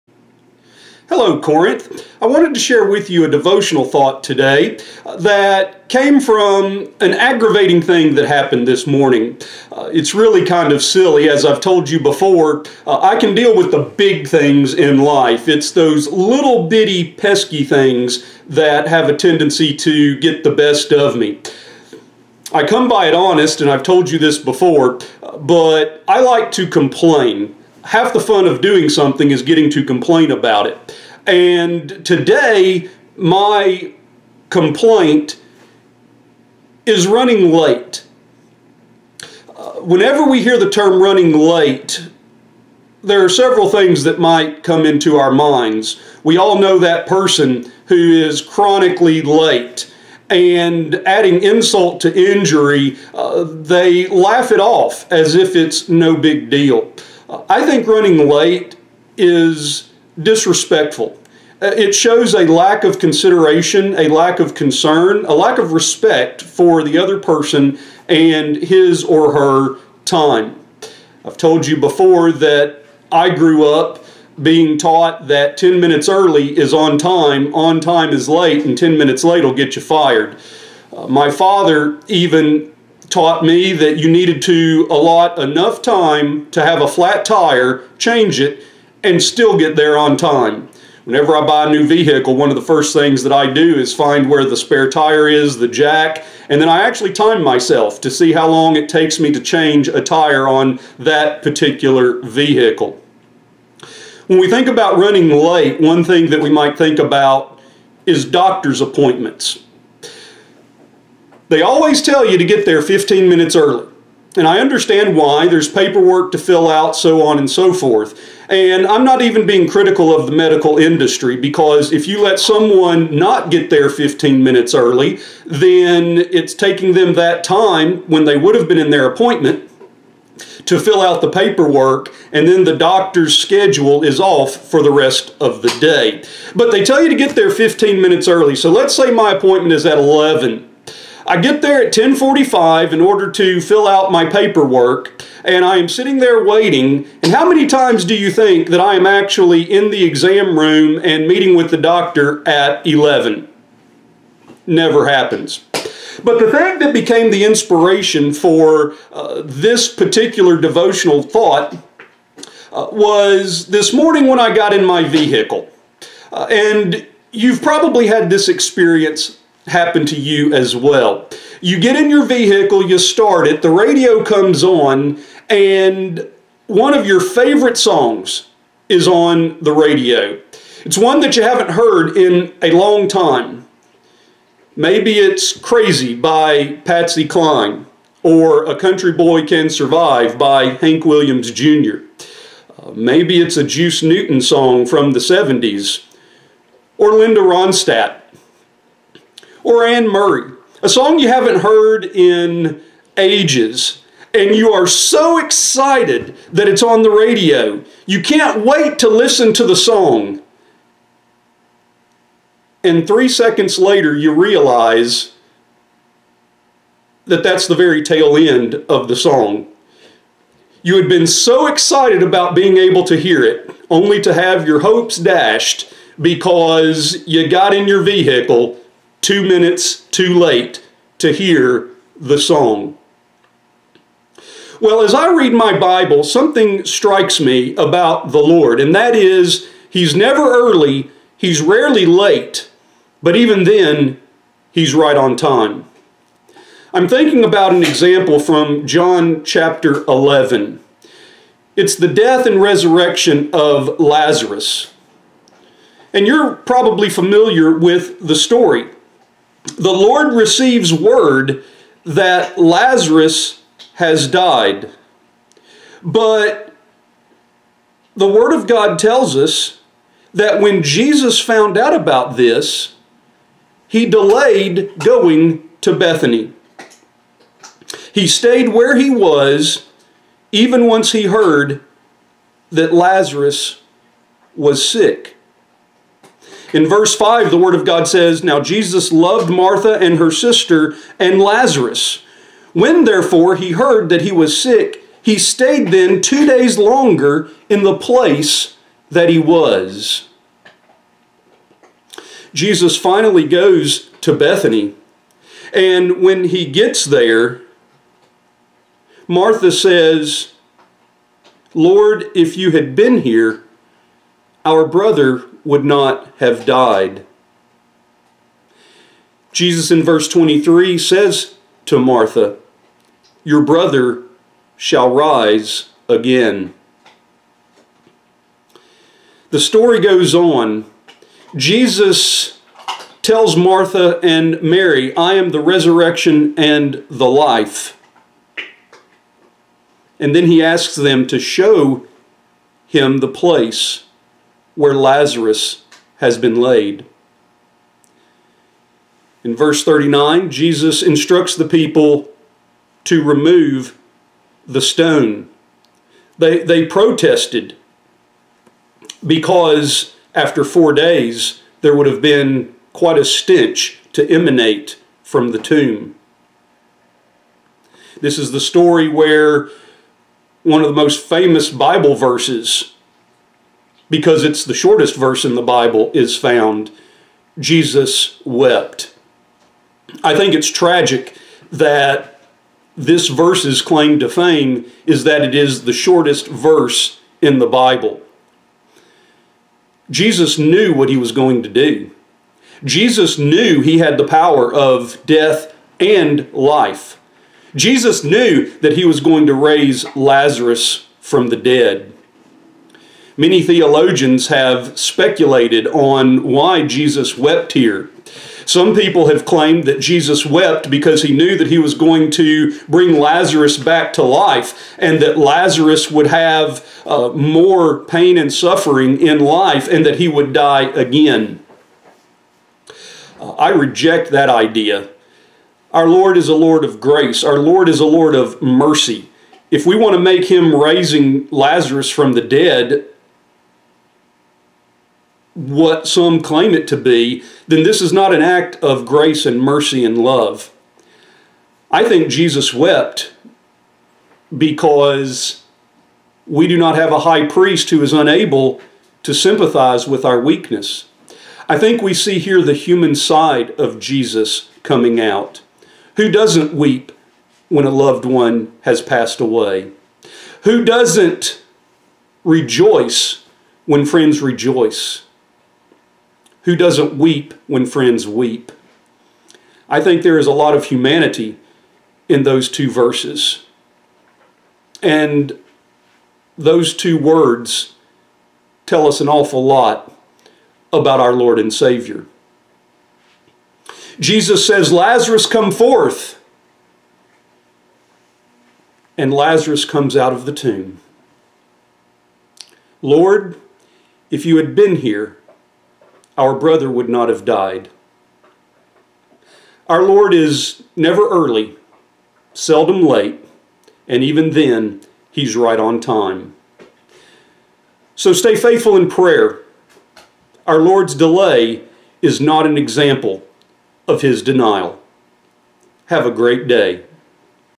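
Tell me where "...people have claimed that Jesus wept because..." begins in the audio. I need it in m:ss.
6:48.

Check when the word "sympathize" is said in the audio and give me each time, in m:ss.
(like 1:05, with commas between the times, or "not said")
7:29.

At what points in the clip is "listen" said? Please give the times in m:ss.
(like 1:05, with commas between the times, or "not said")
3:29.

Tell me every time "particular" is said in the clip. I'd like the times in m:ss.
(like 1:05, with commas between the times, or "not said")
1:41, 2:39.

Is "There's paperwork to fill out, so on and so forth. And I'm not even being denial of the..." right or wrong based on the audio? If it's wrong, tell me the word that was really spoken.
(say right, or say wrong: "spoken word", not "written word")
wrong: "critical", not "denial".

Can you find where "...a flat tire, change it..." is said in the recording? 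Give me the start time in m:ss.
1:26.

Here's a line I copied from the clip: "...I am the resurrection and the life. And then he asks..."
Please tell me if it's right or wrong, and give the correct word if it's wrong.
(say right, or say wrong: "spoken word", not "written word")
right.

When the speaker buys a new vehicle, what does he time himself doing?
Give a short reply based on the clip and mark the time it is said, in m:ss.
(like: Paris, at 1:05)
change a tire, at 1:39.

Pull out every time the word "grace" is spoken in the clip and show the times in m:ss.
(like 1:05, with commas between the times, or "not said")
7:07, 7:19.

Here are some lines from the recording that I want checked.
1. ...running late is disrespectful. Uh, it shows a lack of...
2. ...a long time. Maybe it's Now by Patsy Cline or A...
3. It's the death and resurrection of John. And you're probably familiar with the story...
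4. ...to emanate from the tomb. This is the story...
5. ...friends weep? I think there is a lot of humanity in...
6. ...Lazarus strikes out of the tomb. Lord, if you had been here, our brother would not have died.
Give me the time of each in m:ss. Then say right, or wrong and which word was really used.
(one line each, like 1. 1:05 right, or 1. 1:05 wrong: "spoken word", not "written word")
1. 0:57 right
2. 3:02 wrong: "Crazy", not "Now"
3. 4:11 wrong: "Lazarus", not "John"
4. 6:04 right
5. 7:47 right
6. 8:09 wrong: "comes", not "strikes".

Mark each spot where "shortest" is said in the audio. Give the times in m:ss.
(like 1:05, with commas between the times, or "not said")
6:14, 6:25.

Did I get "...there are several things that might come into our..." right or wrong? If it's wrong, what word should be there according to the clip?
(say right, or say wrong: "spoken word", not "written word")
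right.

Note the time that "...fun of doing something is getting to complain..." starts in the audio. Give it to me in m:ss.
0:28.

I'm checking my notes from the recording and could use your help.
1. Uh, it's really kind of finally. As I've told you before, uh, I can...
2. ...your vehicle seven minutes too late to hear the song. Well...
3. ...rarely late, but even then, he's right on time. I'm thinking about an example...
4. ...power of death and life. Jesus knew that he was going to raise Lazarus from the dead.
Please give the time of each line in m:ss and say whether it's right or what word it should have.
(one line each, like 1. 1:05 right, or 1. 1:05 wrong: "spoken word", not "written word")
1. 0:09 wrong: "silly", not "finally"
2. 3:47 wrong: "two", not "seven"
3. 4:01 right
4. 6:34 right.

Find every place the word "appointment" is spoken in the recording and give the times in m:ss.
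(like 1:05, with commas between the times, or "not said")
1:48, 2:09, 2:19.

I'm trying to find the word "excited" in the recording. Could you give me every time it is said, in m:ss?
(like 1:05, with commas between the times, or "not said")
3:25, 3:41.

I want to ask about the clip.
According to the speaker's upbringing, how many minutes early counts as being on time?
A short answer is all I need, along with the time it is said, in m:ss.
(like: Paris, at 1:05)
10, at 1:15.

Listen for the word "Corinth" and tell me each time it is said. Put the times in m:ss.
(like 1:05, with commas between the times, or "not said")
0:01.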